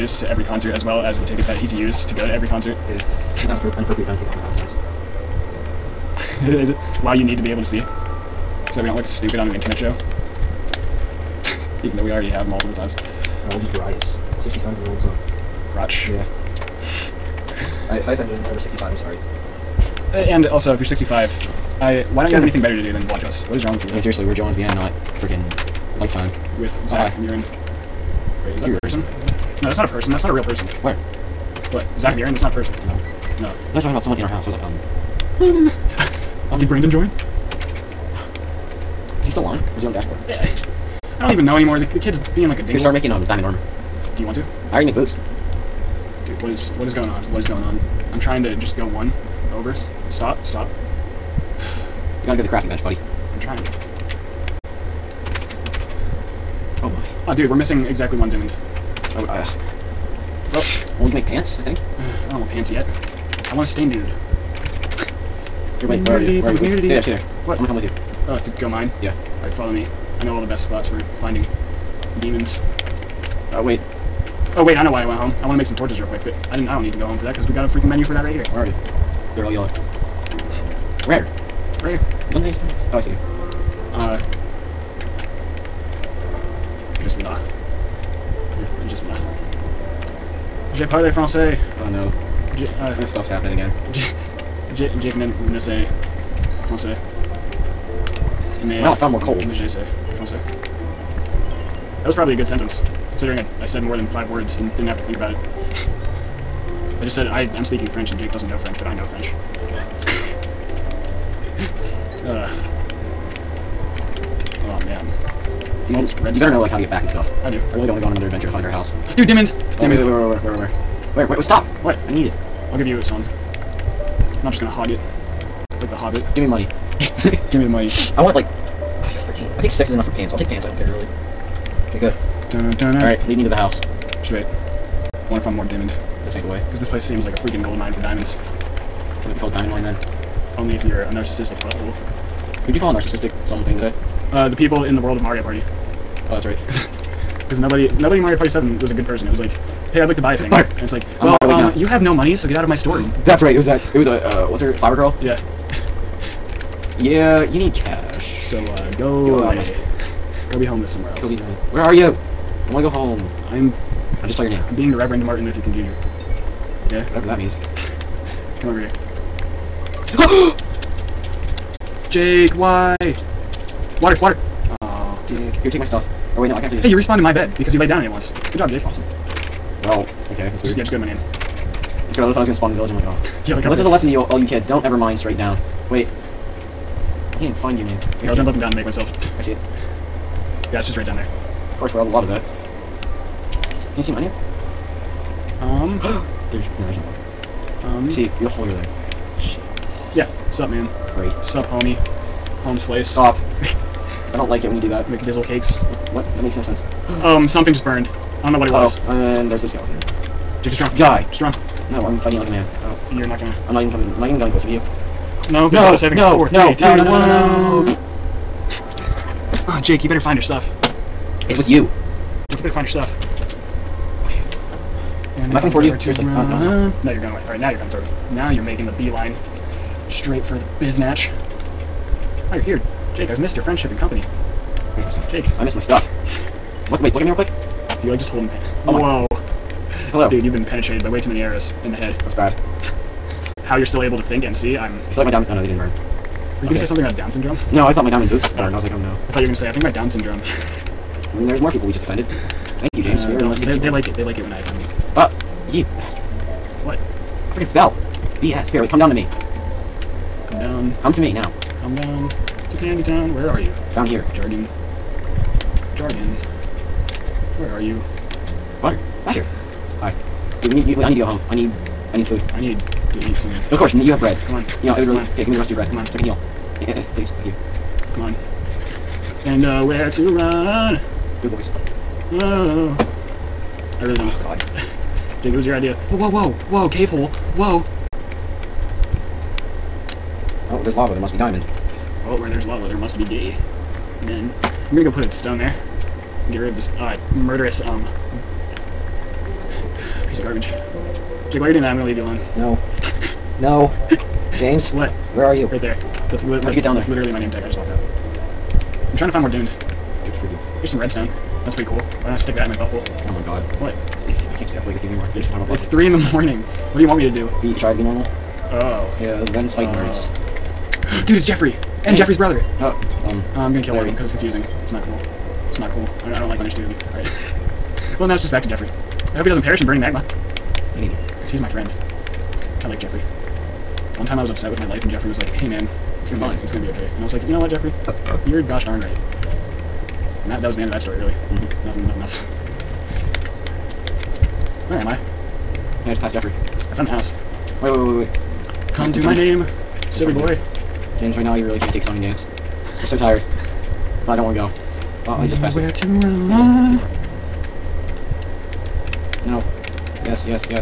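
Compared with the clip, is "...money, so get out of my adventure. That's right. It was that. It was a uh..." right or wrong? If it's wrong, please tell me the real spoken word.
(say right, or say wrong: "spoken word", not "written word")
wrong: "store", not "adventure".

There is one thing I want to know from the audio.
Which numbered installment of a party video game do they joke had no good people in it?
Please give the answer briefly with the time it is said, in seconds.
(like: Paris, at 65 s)
Mario Party 7, at 148 s.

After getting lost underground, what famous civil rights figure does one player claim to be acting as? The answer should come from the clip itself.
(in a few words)
Martin Luther King Jr.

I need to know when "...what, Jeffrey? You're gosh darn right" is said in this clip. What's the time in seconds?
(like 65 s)
337 s.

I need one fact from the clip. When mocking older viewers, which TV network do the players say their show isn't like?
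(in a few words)
Lifetime.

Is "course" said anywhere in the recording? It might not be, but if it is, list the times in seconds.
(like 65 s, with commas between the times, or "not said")
191 s, 273 s.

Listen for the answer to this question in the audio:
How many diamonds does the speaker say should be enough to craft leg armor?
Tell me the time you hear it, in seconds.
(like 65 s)
129 s.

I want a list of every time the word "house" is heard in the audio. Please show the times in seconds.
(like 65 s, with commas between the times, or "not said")
34 s, 118 s, 133 s, 347 s.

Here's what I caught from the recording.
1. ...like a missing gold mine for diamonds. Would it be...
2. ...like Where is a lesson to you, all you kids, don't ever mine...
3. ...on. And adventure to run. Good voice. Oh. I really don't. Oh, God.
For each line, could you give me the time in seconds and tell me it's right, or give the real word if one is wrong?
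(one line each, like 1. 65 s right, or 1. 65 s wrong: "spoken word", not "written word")
1. 137 s wrong: "freaking", not "missing"
2. 183 s wrong: "Unless", not "Where"
3. 278 s wrong: "nowhere", not "adventure".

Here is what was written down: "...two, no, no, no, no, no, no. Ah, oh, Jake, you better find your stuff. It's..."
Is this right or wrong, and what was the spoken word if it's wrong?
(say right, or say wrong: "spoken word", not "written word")
right.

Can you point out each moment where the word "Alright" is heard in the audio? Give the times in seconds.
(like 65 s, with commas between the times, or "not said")
132 s, 227 s.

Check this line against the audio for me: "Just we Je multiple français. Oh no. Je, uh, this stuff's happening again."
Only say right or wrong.
wrong.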